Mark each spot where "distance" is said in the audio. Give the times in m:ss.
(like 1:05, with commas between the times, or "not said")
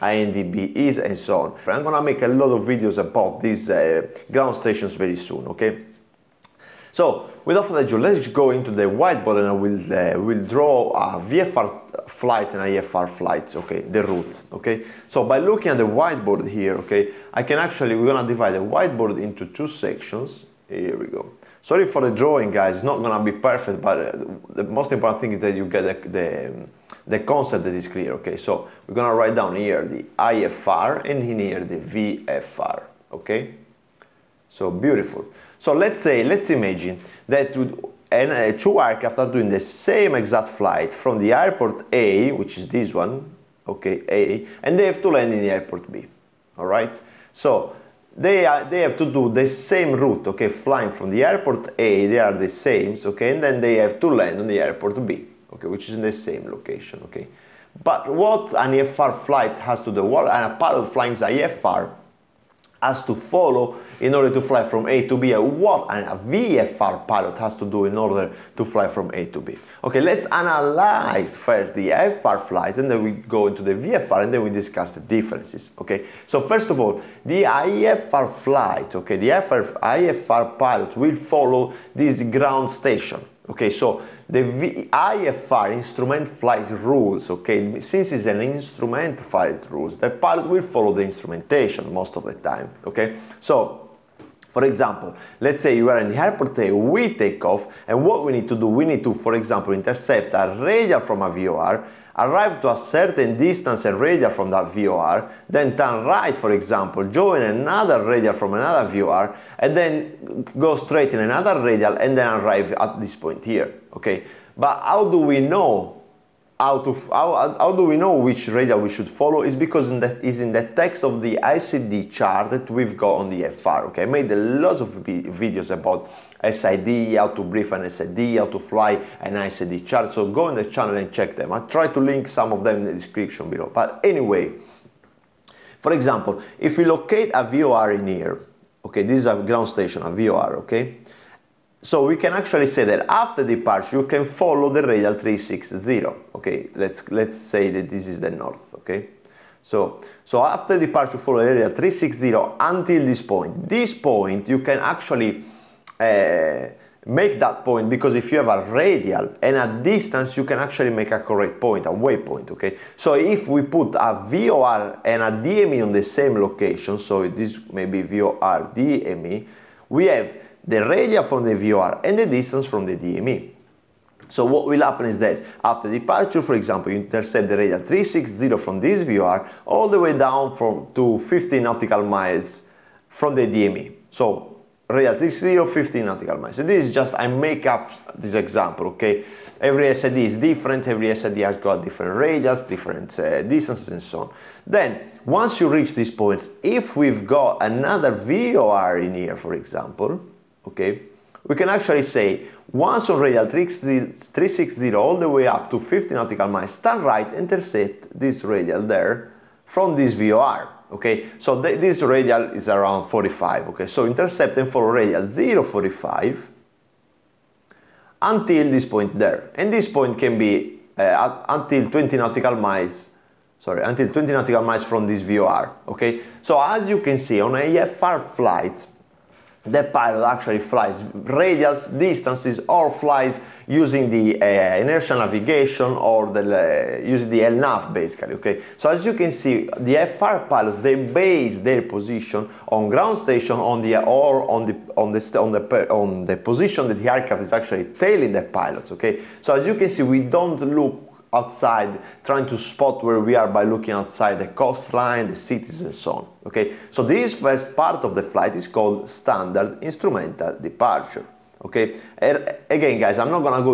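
1:43, 2:39, 2:52, 3:13, 3:51.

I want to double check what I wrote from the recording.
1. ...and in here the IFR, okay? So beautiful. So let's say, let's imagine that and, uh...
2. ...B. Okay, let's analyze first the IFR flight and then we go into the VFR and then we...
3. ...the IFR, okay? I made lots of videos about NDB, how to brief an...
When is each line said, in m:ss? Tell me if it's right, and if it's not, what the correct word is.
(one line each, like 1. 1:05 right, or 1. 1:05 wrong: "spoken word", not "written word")
1. 0:31 wrong: "VFR", not "IFR"
2. 1:09 right
3. 2:03 wrong: "SID", not "NDB".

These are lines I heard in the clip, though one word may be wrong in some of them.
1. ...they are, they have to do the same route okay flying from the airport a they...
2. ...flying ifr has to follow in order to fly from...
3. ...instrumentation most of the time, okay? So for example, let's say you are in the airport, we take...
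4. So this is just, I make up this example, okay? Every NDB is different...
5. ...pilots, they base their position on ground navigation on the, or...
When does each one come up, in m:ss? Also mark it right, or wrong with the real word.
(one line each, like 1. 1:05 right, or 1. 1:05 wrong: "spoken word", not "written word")
1. 0:48 right
2. 1:00 right
3. 1:31 right
4. 3:06 wrong: "SID", not "NDB"
5. 4:00 wrong: "station", not "navigation".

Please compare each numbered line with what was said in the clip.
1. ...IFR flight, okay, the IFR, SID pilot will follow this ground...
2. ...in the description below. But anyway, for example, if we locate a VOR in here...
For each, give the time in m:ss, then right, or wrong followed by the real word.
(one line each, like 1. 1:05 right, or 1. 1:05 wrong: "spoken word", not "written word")
1. 1:17 wrong: "IFR", not "SID"
2. 2:12 right.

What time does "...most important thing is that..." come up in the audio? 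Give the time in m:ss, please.
0:24.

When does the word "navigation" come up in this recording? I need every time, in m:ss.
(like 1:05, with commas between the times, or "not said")
3:55.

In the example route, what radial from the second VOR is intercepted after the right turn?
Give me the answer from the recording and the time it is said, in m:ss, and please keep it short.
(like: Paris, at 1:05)
045, at 3:35.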